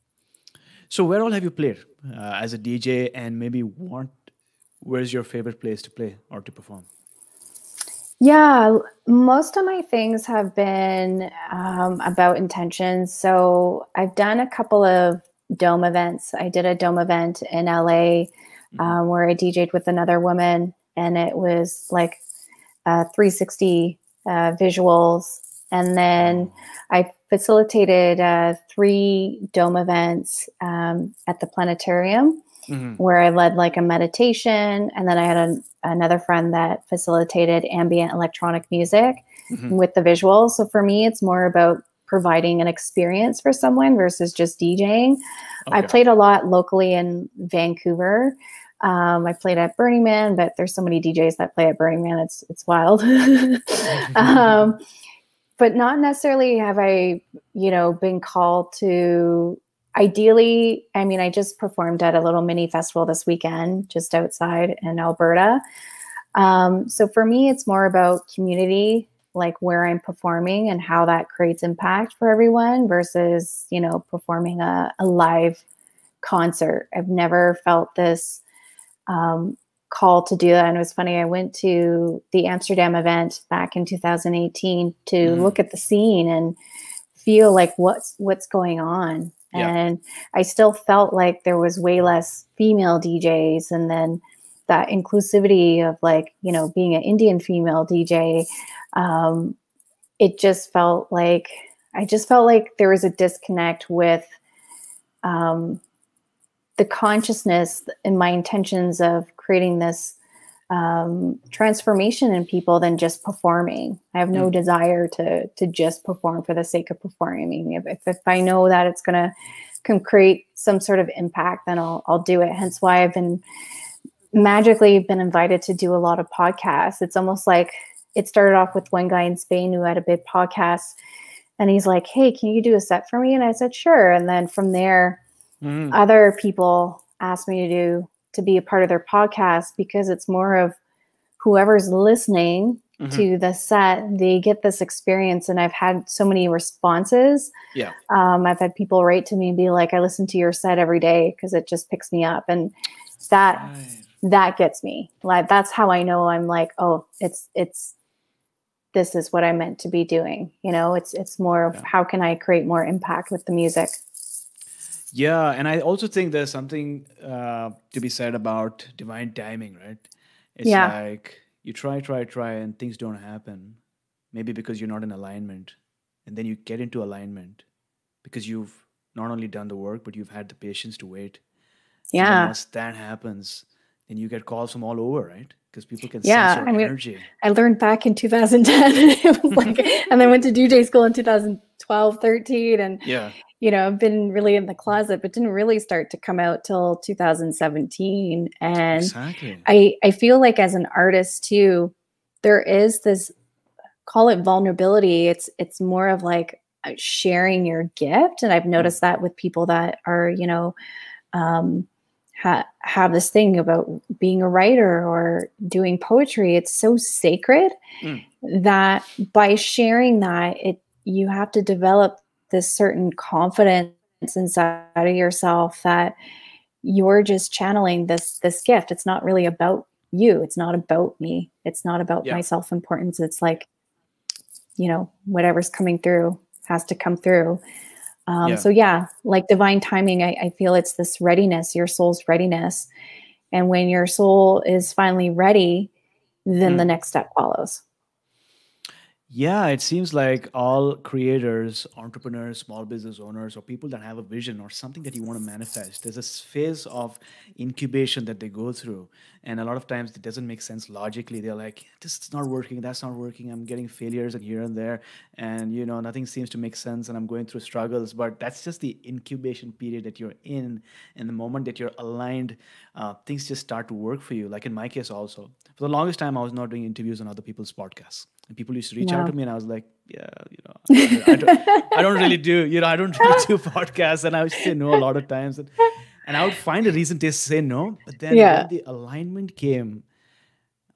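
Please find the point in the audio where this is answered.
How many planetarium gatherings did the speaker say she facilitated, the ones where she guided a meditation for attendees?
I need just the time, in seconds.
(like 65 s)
28 s.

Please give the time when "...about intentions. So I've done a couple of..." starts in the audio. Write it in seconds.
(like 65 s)
12 s.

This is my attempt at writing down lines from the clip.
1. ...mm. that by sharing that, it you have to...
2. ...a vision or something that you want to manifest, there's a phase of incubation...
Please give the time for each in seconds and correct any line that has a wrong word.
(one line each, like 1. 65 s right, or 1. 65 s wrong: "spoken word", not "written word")
1. 218 s right
2. 254 s right.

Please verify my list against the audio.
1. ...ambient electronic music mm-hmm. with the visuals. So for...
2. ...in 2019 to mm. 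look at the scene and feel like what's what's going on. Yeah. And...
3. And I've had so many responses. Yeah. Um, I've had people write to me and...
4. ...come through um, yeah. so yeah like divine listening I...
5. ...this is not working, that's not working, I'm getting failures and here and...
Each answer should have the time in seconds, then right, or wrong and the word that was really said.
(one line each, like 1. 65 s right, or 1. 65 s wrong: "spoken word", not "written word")
1. 37 s right
2. 83 s wrong: "2018", not "2019"
3. 145 s right
4. 236 s wrong: "timing", not "listening"
5. 262 s right.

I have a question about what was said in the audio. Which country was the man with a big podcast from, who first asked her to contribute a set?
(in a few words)
Spain.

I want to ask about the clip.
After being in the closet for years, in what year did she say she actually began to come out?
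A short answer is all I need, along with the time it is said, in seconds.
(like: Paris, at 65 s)
2017, at 196 s.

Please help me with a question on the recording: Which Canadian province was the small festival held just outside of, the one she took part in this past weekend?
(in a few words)
Alberta.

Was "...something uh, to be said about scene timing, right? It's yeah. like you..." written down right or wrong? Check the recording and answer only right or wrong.
wrong.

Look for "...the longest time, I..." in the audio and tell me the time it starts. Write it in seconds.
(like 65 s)
275 s.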